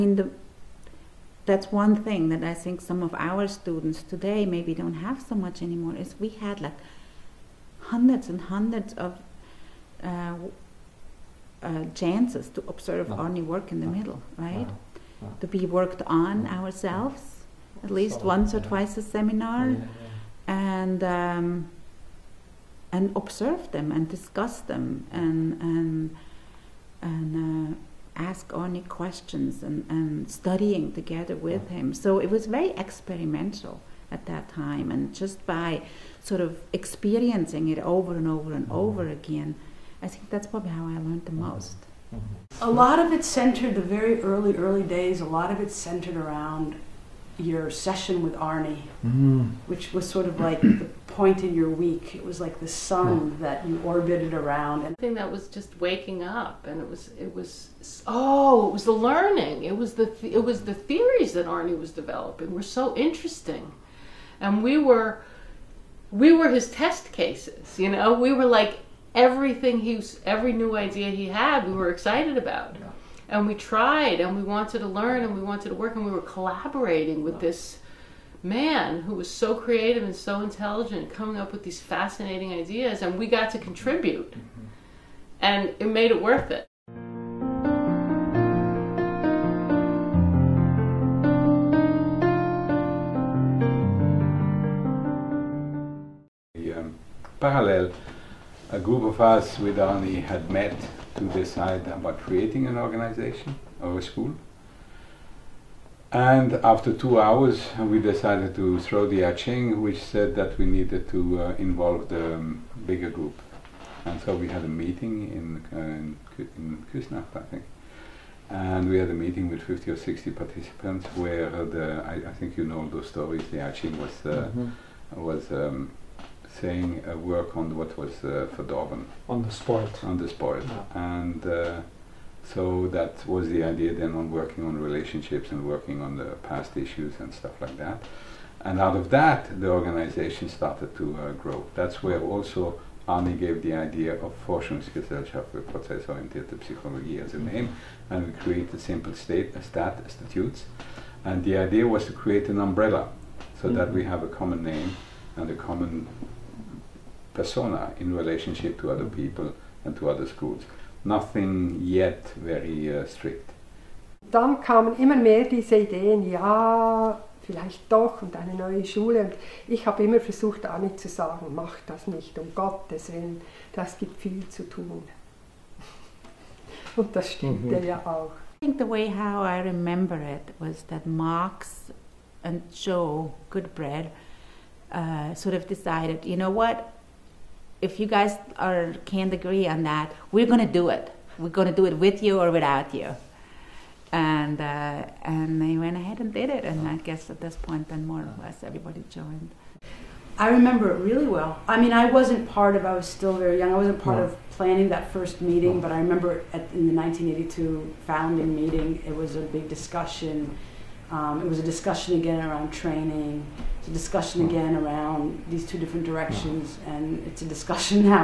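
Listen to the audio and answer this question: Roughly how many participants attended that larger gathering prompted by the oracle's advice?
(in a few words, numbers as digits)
50 or 60.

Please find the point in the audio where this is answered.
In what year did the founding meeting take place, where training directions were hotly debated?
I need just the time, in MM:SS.
03:26.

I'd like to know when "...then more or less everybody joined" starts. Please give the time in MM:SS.
03:17.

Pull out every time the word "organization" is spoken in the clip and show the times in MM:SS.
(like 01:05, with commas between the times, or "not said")
01:42, 02:19.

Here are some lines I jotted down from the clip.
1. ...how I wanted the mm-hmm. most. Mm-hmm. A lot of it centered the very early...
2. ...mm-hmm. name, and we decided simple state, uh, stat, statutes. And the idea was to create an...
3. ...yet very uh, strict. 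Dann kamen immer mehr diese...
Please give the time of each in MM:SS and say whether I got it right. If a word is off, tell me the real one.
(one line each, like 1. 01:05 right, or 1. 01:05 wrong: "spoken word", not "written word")
1. 00:40 wrong: "learned", not "wanted"
2. 02:27 wrong: "created", not "decided"
3. 02:41 right.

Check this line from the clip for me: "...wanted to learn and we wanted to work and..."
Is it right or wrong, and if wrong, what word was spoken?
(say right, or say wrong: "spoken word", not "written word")
right.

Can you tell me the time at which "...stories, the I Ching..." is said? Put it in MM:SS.
02:03.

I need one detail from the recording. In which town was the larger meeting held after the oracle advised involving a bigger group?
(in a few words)
Küsnacht.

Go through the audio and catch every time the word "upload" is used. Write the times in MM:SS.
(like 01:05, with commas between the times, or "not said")
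not said.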